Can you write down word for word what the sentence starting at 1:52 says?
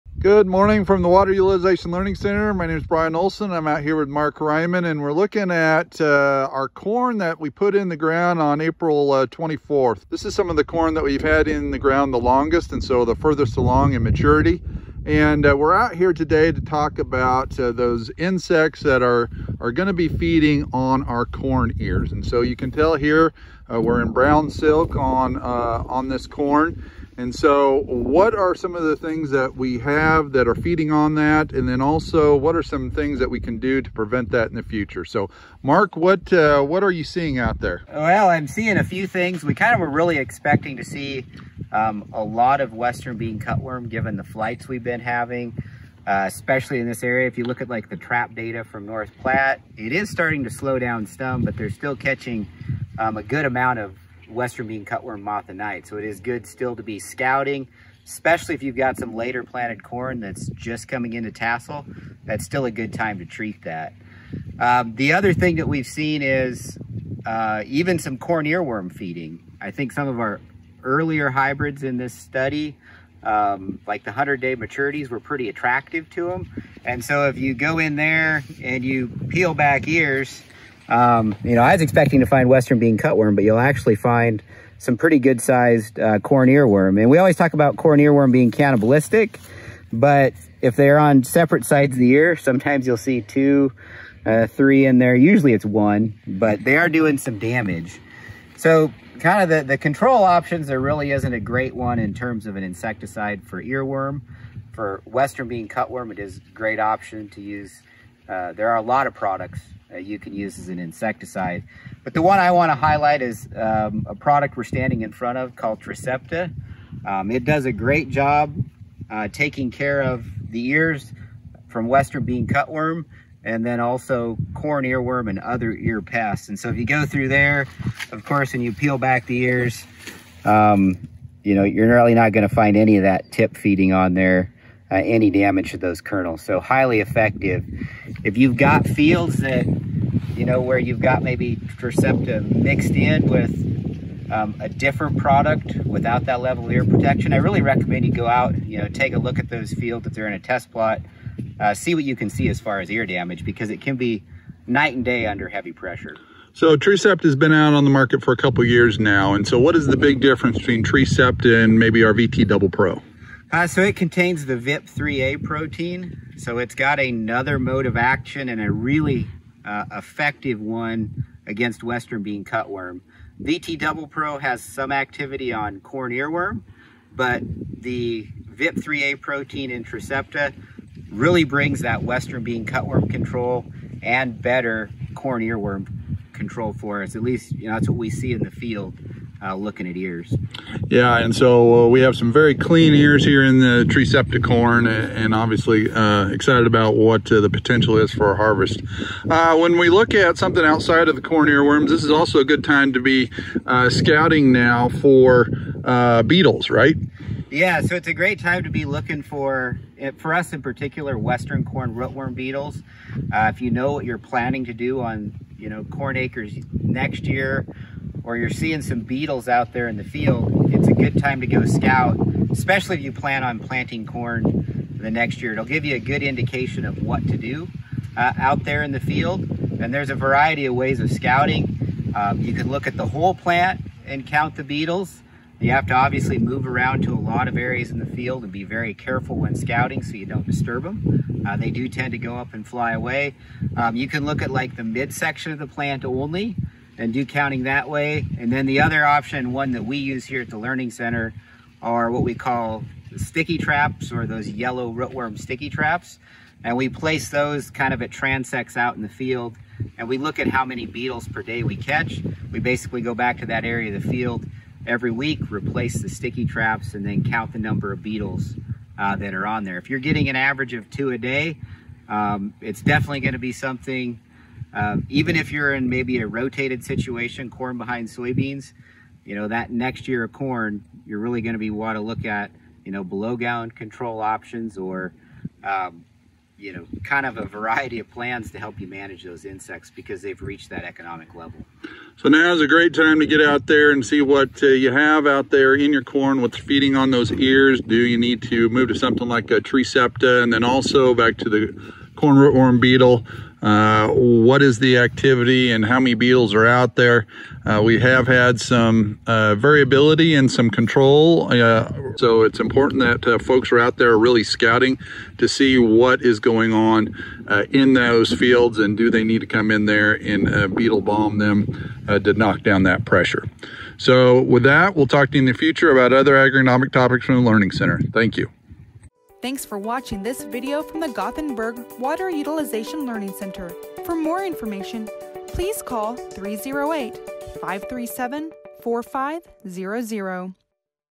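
But the one I want to highlight is um, a product we're standing in front of called Trecepta.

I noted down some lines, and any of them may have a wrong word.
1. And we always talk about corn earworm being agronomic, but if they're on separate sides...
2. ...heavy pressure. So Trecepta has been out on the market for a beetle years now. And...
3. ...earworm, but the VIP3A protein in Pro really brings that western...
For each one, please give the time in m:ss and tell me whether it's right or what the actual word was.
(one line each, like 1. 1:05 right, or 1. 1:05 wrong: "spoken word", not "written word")
1. 1:26 wrong: "cannibalistic", not "agronomic"
2. 2:35 wrong: "couple", not "beetle"
3. 2:56 wrong: "Trecepta", not "Pro".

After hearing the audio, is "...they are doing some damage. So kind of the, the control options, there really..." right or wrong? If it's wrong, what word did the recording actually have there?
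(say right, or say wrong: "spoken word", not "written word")
right.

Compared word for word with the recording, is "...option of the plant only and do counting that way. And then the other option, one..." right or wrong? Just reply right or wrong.
wrong.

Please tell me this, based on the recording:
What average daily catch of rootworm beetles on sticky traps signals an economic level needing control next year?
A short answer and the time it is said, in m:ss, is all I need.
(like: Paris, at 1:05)
2 a day, at 4:30.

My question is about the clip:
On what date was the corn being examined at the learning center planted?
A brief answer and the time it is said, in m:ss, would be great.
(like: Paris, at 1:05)
April 24, at 0:08.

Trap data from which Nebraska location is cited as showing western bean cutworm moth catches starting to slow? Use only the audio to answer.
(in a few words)
North Platte.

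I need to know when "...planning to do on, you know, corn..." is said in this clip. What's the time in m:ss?
3:34.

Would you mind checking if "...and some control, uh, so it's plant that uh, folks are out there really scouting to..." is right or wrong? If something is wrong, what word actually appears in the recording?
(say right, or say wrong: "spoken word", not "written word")
wrong: "important", not "plant".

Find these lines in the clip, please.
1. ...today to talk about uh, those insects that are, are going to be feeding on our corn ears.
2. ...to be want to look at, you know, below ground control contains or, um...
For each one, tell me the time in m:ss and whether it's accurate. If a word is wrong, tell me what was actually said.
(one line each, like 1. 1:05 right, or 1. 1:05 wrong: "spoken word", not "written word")
1. 0:16 right
2. 4:41 wrong: "options", not "contains".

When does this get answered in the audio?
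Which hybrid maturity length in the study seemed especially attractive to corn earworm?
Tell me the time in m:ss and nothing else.
1:14.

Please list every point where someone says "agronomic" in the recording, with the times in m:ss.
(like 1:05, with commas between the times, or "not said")
5:26.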